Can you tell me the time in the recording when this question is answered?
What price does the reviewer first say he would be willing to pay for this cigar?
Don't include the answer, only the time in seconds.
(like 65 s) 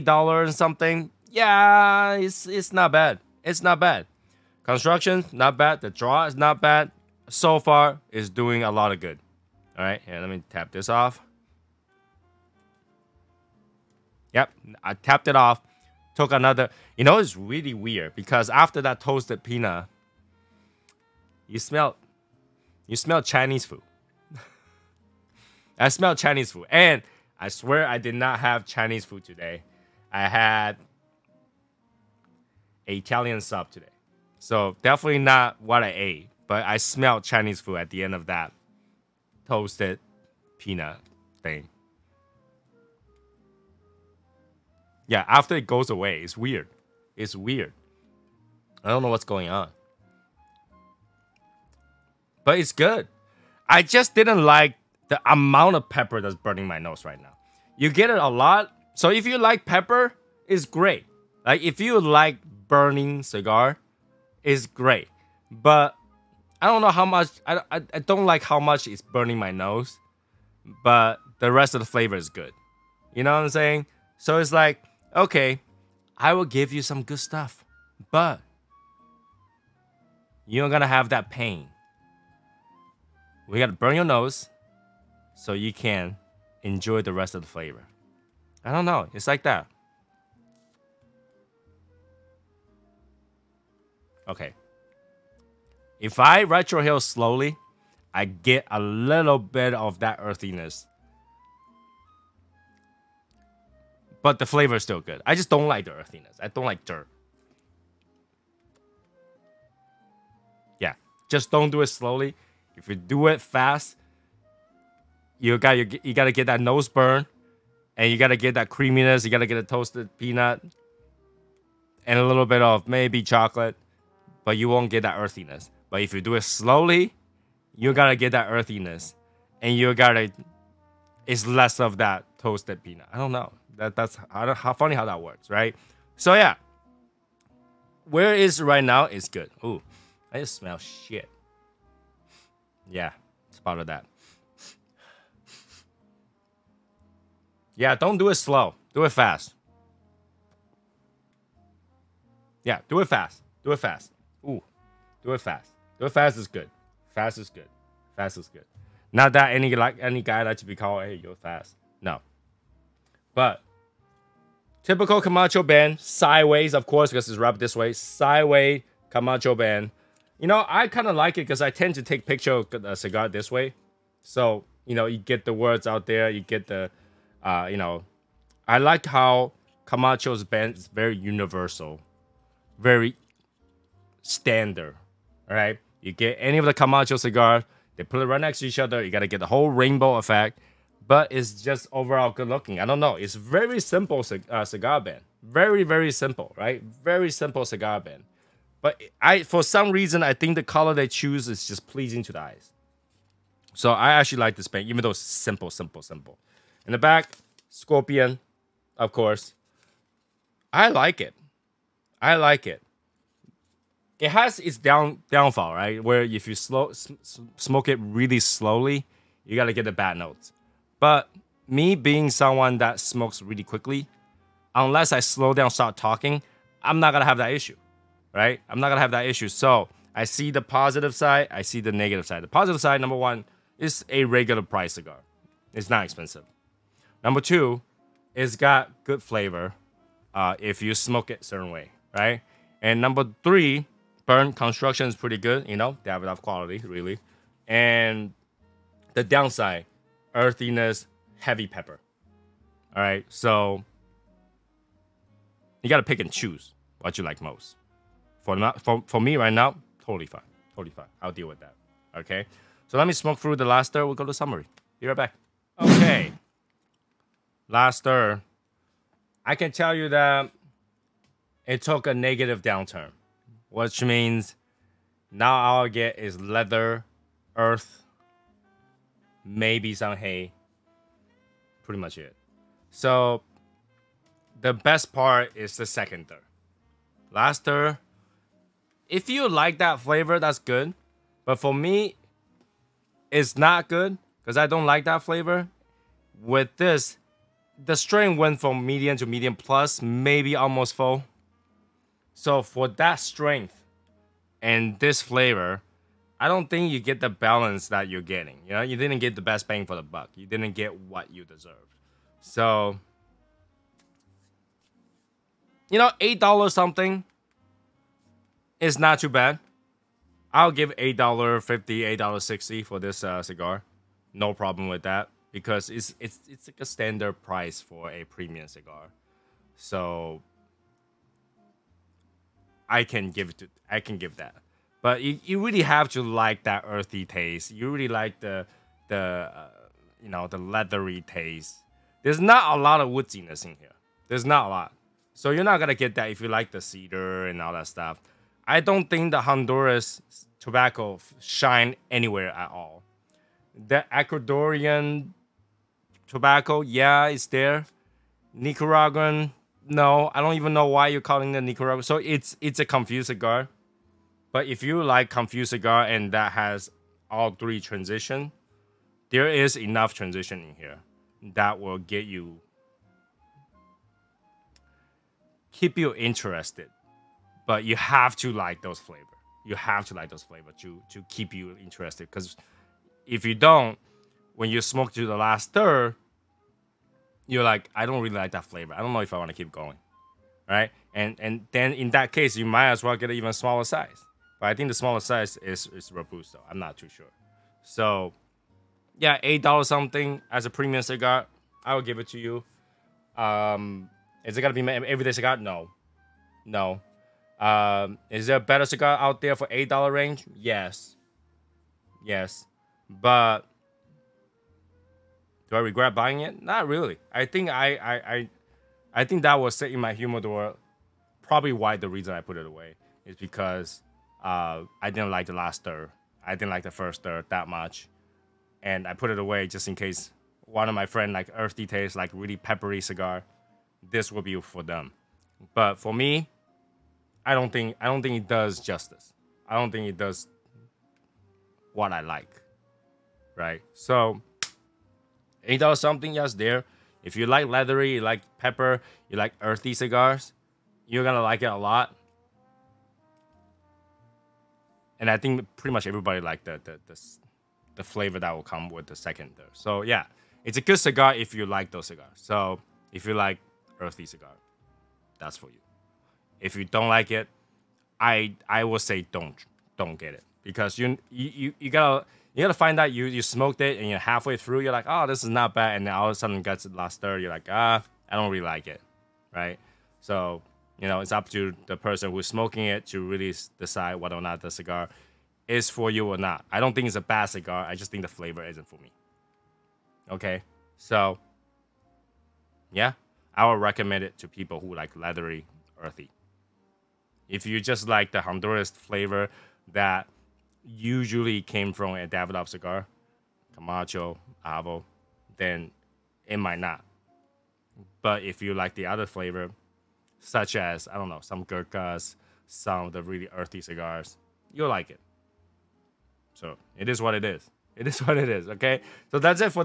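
320 s.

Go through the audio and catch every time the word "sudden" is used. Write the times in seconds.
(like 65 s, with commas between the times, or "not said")
476 s.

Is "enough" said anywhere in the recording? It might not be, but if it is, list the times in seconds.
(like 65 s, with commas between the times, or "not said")
246 s, 369 s.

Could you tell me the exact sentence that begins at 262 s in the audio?
Okay, so let me smoke through the last third.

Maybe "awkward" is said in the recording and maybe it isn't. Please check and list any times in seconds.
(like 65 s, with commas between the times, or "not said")
not said.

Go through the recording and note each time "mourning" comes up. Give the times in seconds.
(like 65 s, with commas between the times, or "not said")
not said.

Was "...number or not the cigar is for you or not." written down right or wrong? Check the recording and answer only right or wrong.
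wrong.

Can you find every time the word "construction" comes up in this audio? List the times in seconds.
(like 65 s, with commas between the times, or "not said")
4 s, 244 s.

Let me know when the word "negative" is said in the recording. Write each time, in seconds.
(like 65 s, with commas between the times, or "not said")
231 s, 272 s.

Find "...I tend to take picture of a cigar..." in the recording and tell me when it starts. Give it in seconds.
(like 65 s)
171 s.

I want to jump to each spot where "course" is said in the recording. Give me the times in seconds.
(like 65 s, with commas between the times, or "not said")
166 s, 209 s.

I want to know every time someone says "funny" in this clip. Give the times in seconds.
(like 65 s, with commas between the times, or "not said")
134 s.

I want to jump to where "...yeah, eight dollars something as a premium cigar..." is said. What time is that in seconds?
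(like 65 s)
399 s.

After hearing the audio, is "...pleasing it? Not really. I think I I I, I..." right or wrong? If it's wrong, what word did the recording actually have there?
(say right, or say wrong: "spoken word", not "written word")
wrong: "buying", not "pleasing".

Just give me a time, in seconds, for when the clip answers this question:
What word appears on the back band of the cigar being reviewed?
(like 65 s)
207 s.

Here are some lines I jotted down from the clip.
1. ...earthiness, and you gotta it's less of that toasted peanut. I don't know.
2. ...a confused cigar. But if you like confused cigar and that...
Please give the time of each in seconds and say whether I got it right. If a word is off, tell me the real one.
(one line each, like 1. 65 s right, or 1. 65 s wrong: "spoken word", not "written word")
1. 128 s right
2. 362 s right.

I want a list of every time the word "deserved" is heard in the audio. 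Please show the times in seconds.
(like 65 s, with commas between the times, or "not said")
311 s.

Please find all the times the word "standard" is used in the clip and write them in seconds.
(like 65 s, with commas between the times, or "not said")
184 s, 326 s.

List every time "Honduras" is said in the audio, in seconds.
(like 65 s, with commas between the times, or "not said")
349 s, 498 s.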